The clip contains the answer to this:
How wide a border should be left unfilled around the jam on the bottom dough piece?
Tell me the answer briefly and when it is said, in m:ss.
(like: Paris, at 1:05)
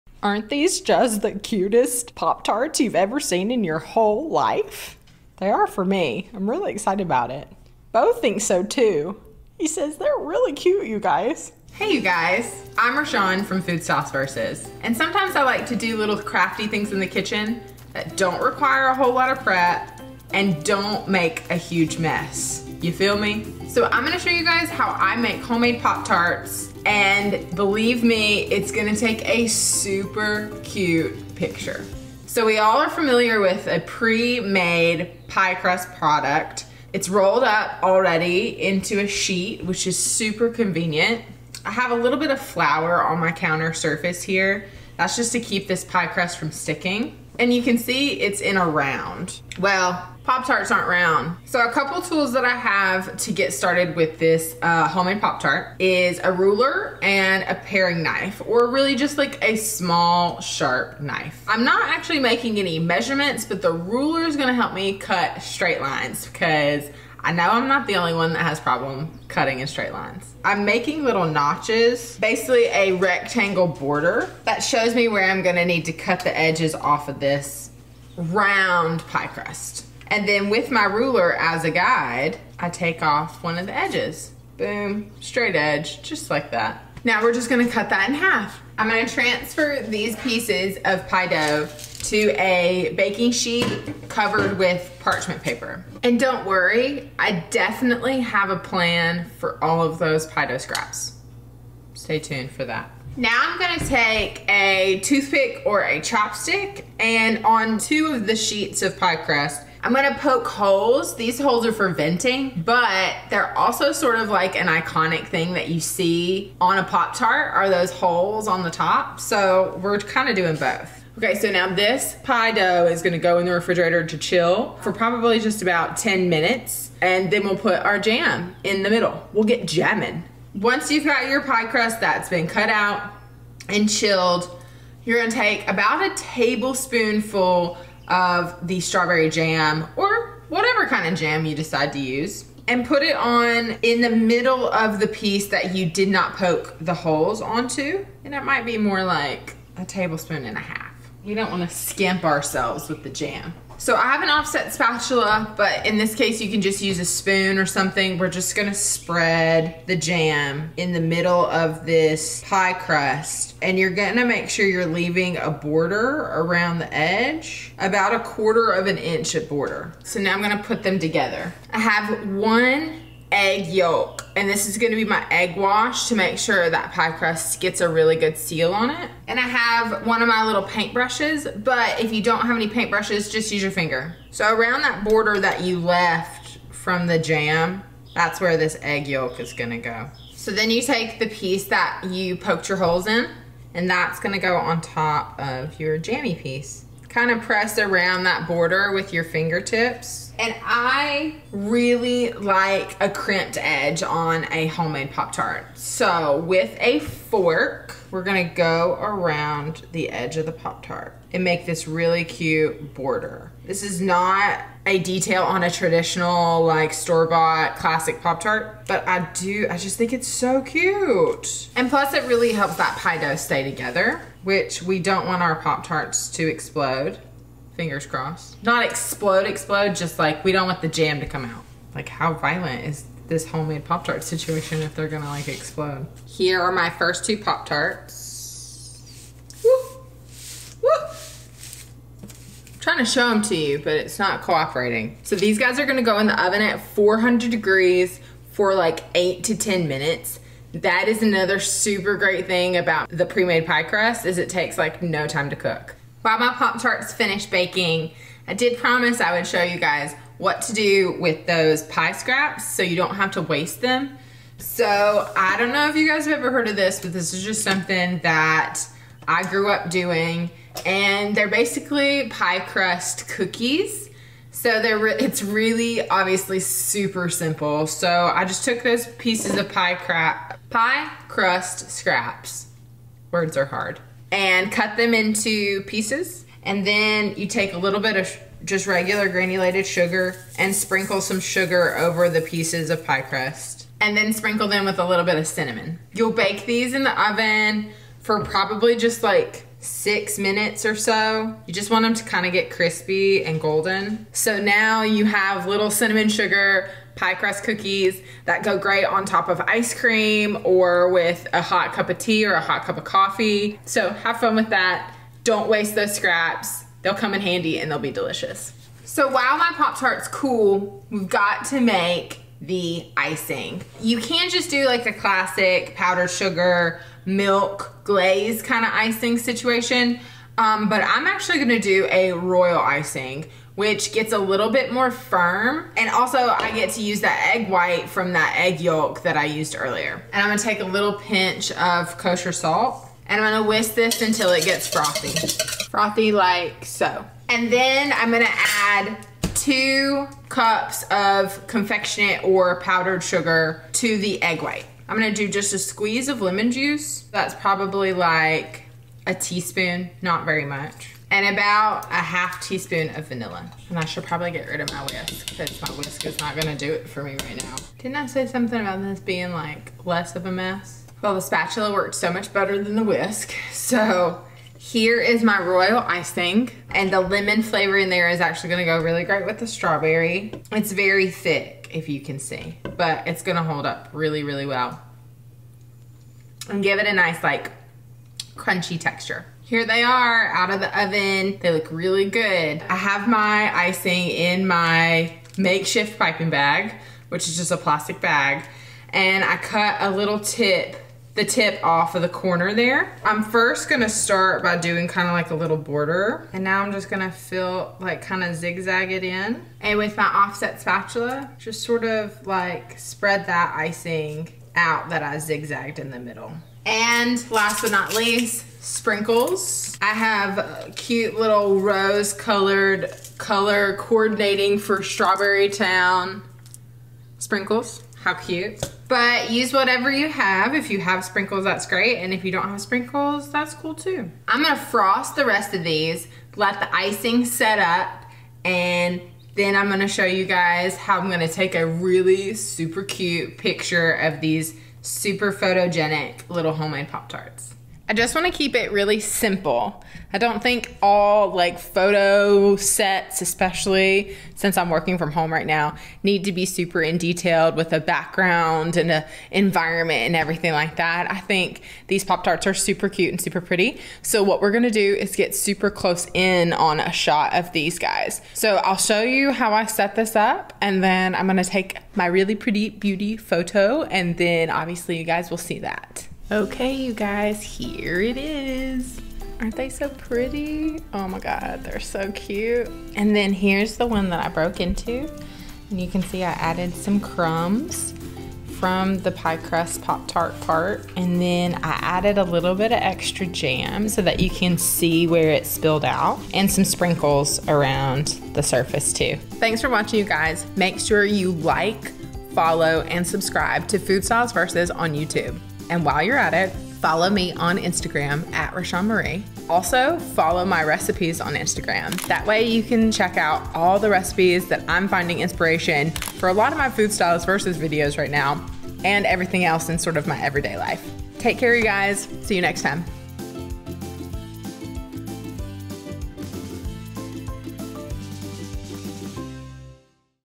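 A quarter of an inch, at 2:48.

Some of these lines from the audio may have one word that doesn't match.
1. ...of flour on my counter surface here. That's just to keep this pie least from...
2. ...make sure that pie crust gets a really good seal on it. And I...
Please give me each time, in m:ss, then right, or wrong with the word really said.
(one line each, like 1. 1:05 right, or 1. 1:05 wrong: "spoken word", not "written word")
1. 0:42 wrong: "crust", not "least"
2. 2:56 right.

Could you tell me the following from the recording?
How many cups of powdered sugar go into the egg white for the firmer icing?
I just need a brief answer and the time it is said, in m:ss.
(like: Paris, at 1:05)
2, at 5:49.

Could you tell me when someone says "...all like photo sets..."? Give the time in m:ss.
7:31.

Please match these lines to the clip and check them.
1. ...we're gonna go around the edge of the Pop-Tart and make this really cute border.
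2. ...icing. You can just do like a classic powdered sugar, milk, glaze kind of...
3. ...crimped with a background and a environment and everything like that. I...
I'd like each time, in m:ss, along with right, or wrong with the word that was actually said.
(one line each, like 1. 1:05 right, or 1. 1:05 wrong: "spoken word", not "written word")
1. 3:28 right
2. 5:23 right
3. 7:37 wrong: "detailed", not "crimped".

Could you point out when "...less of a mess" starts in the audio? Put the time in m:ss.
6:10.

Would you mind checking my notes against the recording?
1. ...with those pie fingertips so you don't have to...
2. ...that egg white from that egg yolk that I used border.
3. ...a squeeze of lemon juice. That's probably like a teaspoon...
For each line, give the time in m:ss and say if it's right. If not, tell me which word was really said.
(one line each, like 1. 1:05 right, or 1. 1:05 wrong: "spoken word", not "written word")
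1. 4:21 wrong: "scraps", not "fingertips"
2. 5:37 wrong: "earlier", not "border"
3. 5:55 right.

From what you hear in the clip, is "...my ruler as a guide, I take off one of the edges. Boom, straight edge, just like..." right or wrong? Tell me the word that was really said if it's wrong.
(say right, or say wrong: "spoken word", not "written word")
right.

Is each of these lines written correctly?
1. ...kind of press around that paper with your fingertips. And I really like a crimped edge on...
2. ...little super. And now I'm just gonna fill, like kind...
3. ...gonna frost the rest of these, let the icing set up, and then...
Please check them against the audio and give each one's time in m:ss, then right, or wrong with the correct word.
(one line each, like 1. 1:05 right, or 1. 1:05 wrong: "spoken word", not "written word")
1. 3:17 wrong: "border", not "paper"
2. 6:45 wrong: "border", not "super"
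3. 7:14 right.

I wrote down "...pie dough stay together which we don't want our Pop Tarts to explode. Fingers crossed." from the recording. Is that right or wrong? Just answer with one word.
right.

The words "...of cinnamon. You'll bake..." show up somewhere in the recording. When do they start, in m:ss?
4:55.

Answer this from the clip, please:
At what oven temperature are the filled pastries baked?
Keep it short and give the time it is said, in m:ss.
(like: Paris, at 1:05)
400 degrees, at 4:06.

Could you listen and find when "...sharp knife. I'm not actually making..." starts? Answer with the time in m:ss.
1:00.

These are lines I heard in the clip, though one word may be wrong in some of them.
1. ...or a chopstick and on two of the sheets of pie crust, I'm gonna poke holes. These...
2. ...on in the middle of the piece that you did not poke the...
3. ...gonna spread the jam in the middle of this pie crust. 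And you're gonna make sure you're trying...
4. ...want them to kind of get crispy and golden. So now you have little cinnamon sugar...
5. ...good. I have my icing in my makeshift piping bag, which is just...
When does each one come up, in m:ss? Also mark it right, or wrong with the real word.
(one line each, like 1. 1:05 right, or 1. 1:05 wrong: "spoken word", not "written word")
1. 1:45 right
2. 2:23 right
3. 2:38 wrong: "leaving", not "trying"
4. 5:01 right
5. 6:32 right.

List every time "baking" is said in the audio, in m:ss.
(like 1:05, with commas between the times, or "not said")
1:32, 4:17.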